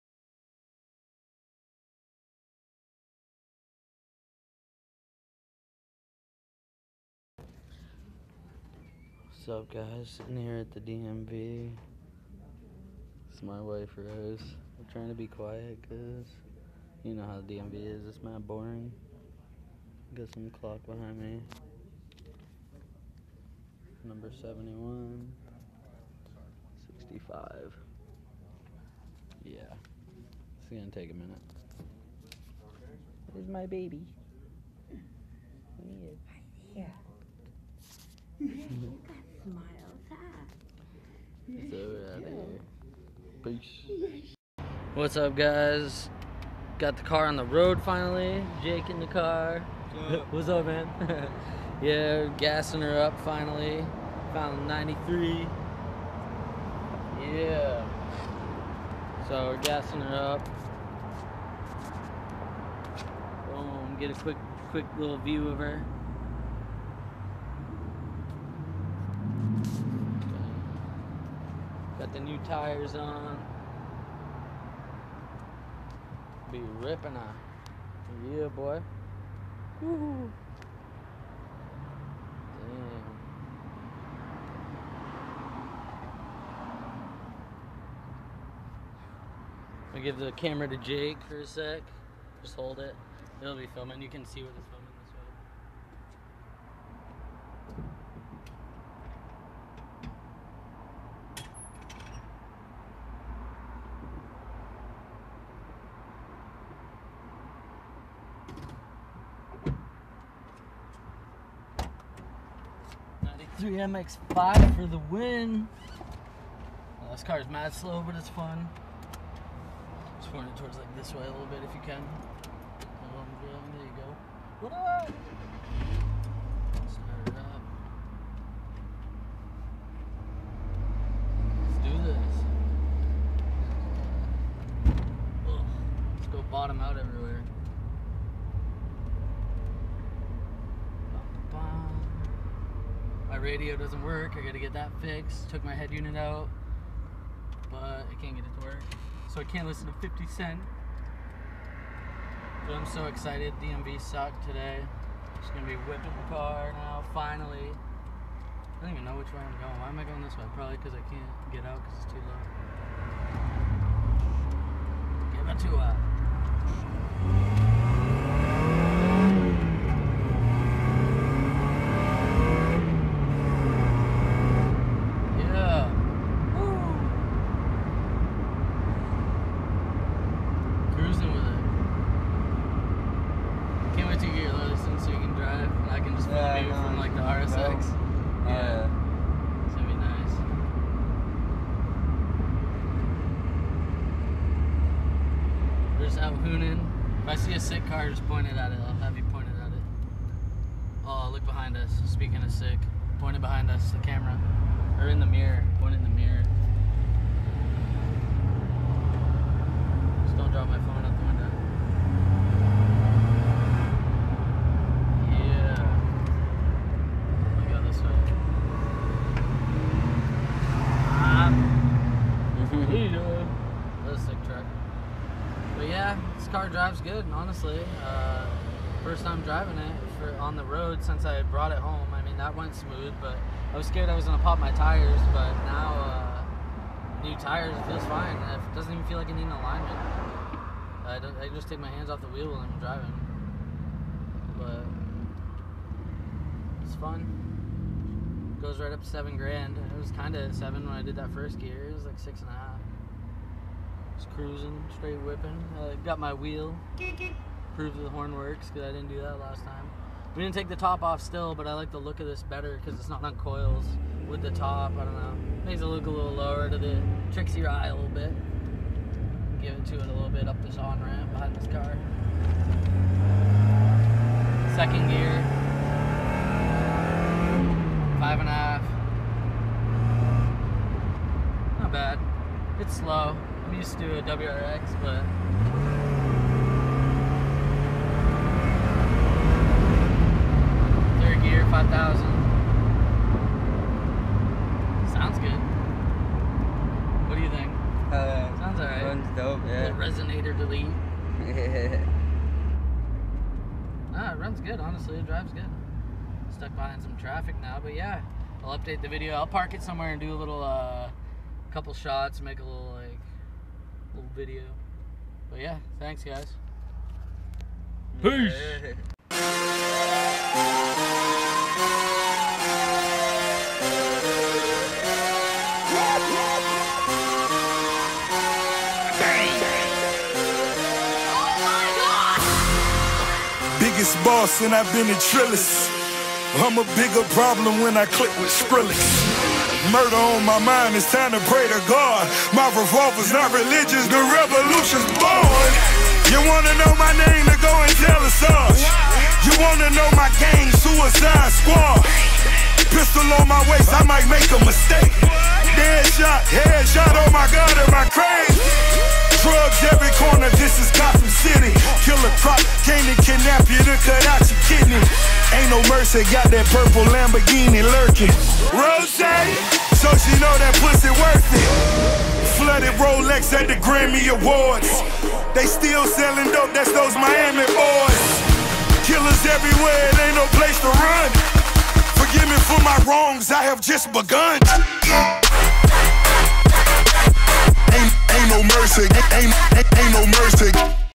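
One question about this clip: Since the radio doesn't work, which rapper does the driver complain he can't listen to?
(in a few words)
50 Cent.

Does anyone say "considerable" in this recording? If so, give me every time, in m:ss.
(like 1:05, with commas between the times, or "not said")
not said.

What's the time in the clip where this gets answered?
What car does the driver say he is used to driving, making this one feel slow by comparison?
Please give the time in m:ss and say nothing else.
4:44.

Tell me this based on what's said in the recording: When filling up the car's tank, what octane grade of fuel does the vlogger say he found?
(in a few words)
93.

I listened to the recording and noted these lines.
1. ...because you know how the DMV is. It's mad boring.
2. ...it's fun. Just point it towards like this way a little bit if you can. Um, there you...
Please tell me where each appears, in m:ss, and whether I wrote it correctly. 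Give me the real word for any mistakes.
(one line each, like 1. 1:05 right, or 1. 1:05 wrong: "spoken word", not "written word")
1. 0:15 right
2. 1:58 right.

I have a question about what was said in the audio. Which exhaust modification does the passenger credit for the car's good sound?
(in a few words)
resonator delete.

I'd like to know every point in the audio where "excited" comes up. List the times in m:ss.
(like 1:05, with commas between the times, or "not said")
2:33.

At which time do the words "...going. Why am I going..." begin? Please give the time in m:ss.
2:39.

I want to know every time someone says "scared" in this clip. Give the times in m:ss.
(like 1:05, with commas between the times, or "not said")
3:53.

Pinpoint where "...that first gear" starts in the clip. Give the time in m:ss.
4:11.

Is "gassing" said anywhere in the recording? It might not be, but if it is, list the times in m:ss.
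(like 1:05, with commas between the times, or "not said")
0:52, 0:59.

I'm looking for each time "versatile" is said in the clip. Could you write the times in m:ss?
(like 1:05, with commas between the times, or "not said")
not said.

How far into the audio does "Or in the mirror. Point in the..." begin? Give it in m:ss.
3:24.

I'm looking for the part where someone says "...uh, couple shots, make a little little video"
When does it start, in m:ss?
5:10.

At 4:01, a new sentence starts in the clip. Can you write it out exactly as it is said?
I, I just take my hands off the wheel when I'm driving, but it's fun.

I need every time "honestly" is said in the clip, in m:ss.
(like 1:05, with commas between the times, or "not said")
3:47, 5:04.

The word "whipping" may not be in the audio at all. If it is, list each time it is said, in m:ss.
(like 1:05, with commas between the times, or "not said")
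2:35, 4:15.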